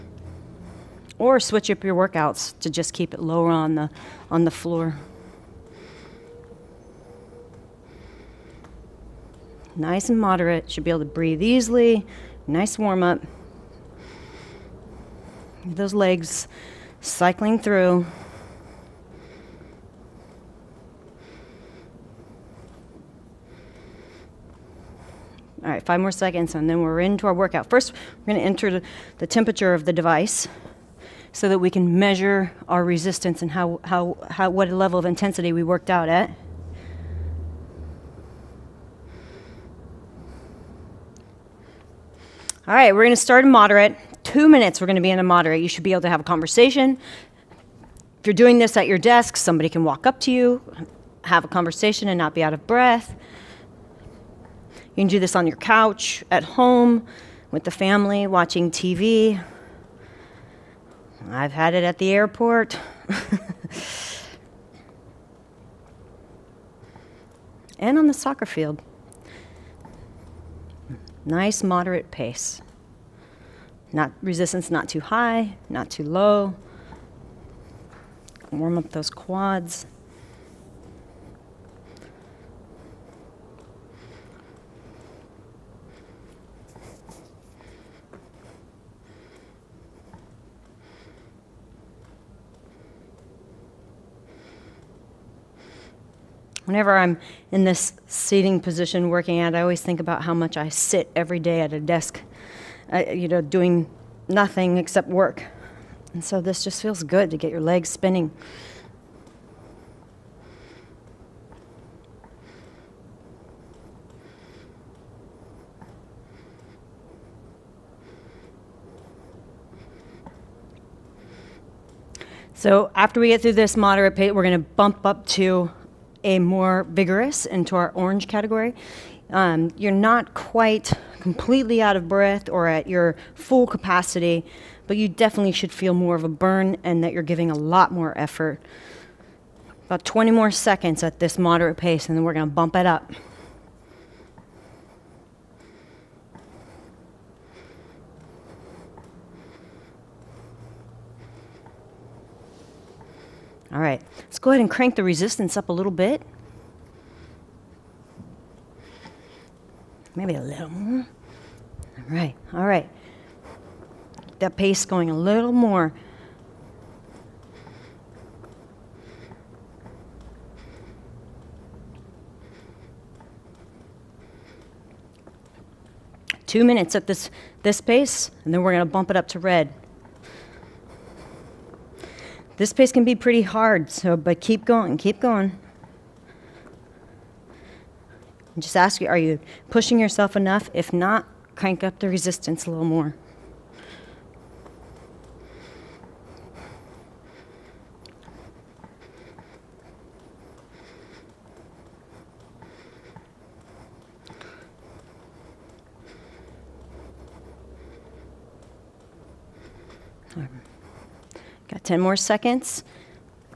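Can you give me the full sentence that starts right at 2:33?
All right, let's go ahead and crank the resistance up a little bit.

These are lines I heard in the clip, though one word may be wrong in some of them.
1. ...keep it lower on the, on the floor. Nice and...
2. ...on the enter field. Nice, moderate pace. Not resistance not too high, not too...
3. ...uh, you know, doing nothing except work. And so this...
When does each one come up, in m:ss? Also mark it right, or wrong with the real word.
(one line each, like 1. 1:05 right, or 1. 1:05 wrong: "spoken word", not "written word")
1. 0:02 right
2. 1:07 wrong: "soccer", not "enter"
3. 1:42 right.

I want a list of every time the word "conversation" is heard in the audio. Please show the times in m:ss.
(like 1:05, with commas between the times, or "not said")
0:46, 0:51.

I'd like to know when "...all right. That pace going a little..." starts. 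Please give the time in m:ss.
2:42.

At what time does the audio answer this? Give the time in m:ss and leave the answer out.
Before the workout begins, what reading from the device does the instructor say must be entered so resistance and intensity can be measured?
0:29.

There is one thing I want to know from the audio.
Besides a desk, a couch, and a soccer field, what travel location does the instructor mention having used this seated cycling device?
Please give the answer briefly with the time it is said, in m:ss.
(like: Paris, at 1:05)
the airport, at 1:01.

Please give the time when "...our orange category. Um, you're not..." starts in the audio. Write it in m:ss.
2:07.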